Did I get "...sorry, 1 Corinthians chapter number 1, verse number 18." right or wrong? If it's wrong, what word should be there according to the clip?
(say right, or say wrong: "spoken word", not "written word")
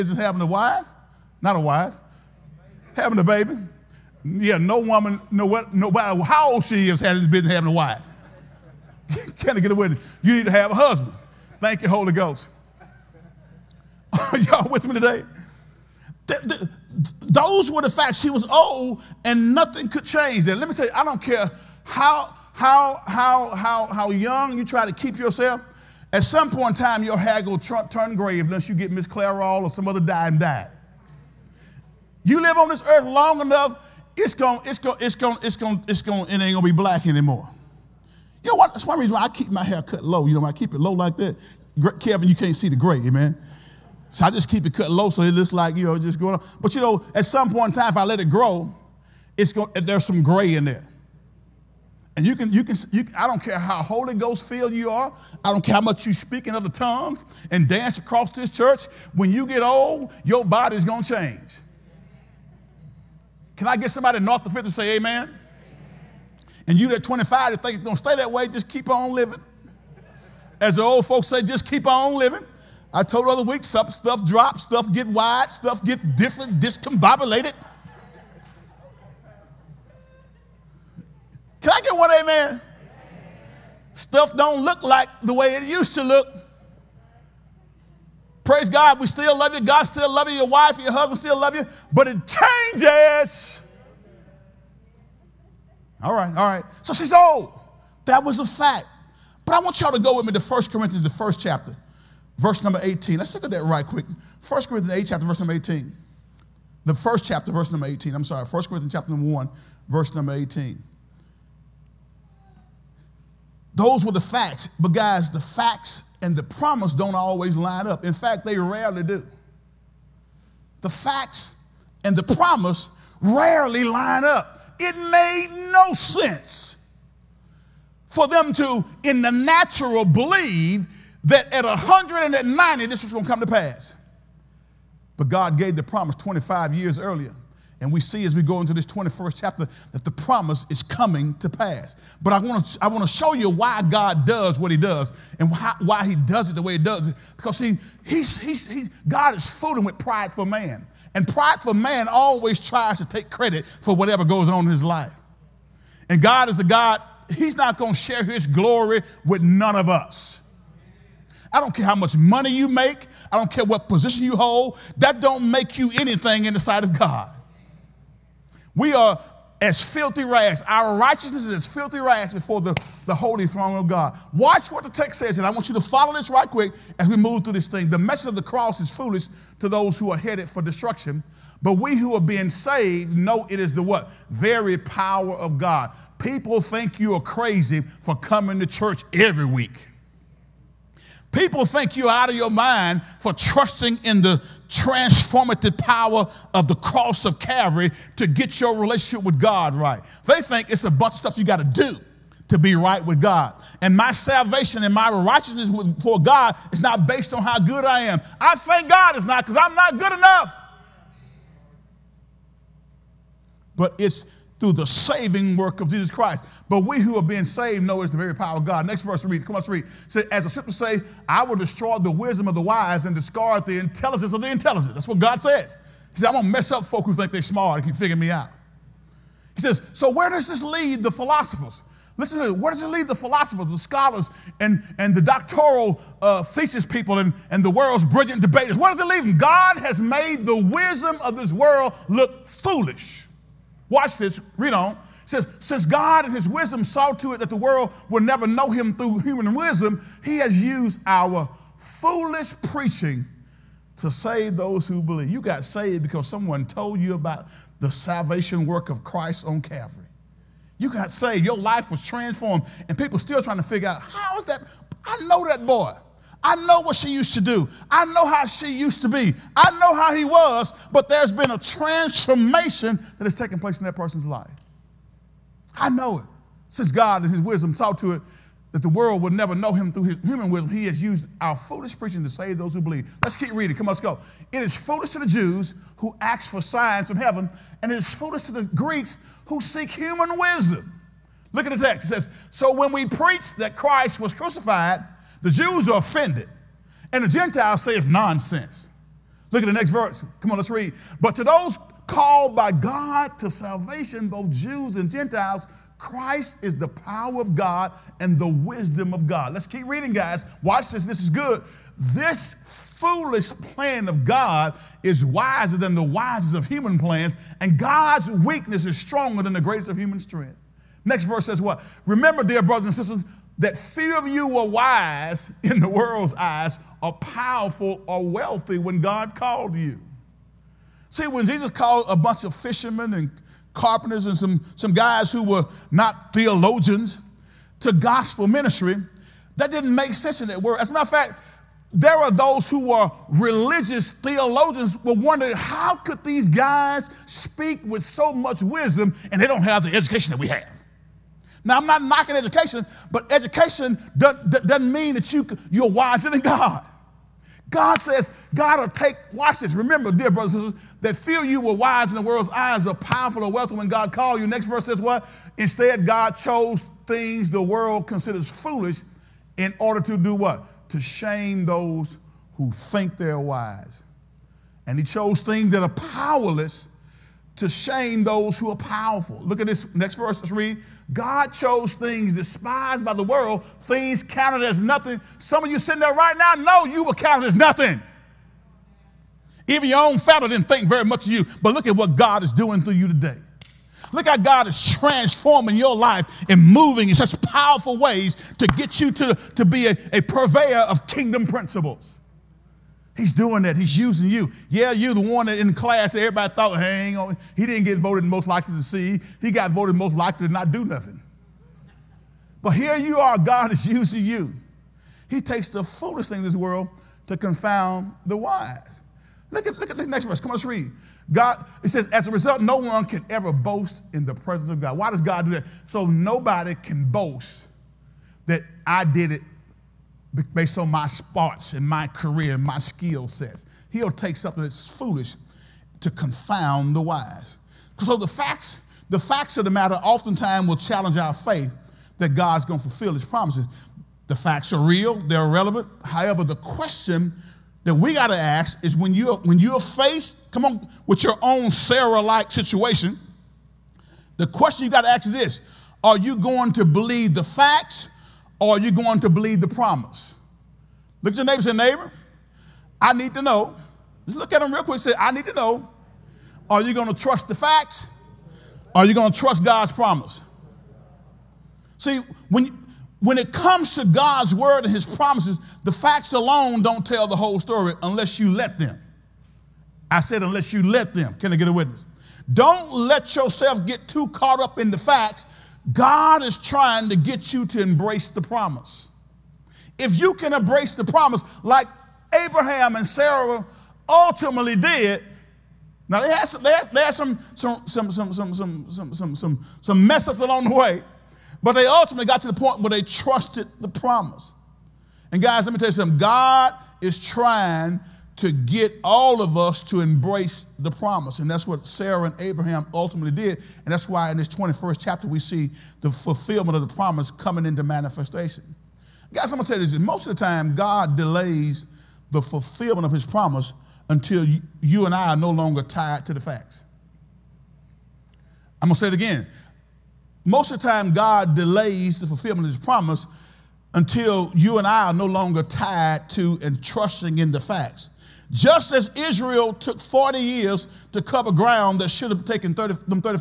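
right.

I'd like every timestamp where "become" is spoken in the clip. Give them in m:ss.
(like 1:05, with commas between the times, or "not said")
not said.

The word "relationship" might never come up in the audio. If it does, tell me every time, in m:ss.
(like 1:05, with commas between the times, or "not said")
3:18.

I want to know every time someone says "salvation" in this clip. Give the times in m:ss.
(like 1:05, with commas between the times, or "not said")
3:24, 4:17, 5:03.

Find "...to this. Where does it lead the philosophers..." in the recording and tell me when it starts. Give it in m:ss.
3:52.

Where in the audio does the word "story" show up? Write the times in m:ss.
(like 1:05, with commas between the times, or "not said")
7:57.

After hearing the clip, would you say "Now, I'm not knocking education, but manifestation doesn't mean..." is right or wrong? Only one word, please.
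wrong.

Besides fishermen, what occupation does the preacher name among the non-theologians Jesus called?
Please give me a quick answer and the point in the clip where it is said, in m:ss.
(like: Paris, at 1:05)
Carpenters, at 5:33.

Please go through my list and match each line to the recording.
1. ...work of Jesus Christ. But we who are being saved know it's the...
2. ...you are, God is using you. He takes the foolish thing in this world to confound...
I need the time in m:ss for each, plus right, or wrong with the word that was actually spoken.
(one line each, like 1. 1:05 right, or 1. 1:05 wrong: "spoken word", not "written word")
1. 3:35 right
2. 6:52 right.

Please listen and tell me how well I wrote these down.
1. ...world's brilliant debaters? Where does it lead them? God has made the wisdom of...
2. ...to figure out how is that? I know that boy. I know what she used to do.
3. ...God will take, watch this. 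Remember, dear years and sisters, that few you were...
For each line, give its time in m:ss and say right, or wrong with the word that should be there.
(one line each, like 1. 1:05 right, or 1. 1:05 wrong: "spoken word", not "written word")
1. 3:57 right
2. 4:23 right
3. 5:58 wrong: "brothers", not "years".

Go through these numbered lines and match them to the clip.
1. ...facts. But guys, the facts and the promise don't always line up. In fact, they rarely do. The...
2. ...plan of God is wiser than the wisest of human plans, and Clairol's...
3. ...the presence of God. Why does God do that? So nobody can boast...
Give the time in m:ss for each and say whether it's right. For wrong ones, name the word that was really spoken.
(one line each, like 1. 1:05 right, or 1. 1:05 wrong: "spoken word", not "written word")
1. 1:54 right
2. 5:13 wrong: "God", not "Clairol"
3. 7:04 right.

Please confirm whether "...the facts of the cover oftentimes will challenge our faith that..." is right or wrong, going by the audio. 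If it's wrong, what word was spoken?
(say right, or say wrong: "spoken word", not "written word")
wrong: "matter", not "cover".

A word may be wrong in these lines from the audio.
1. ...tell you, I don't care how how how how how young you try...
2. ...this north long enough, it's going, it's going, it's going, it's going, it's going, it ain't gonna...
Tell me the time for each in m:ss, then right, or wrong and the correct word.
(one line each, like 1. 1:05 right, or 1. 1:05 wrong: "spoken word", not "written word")
1. 0:20 right
2. 0:32 wrong: "earth", not "north".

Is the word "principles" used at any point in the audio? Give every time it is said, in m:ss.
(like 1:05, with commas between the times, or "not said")
6:41.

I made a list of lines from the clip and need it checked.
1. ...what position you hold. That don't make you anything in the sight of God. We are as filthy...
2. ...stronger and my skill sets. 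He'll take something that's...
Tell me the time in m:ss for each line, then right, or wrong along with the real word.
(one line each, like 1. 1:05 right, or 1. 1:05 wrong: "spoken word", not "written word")
1. 2:43 right
2. 7:12 wrong: "career", not "stronger".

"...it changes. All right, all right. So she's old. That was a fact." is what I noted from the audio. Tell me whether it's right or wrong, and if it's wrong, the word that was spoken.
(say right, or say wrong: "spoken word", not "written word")
right.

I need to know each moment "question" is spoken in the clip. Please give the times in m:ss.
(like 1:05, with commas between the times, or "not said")
7:26, 7:34.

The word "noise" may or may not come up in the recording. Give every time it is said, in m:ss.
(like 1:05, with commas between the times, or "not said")
not said.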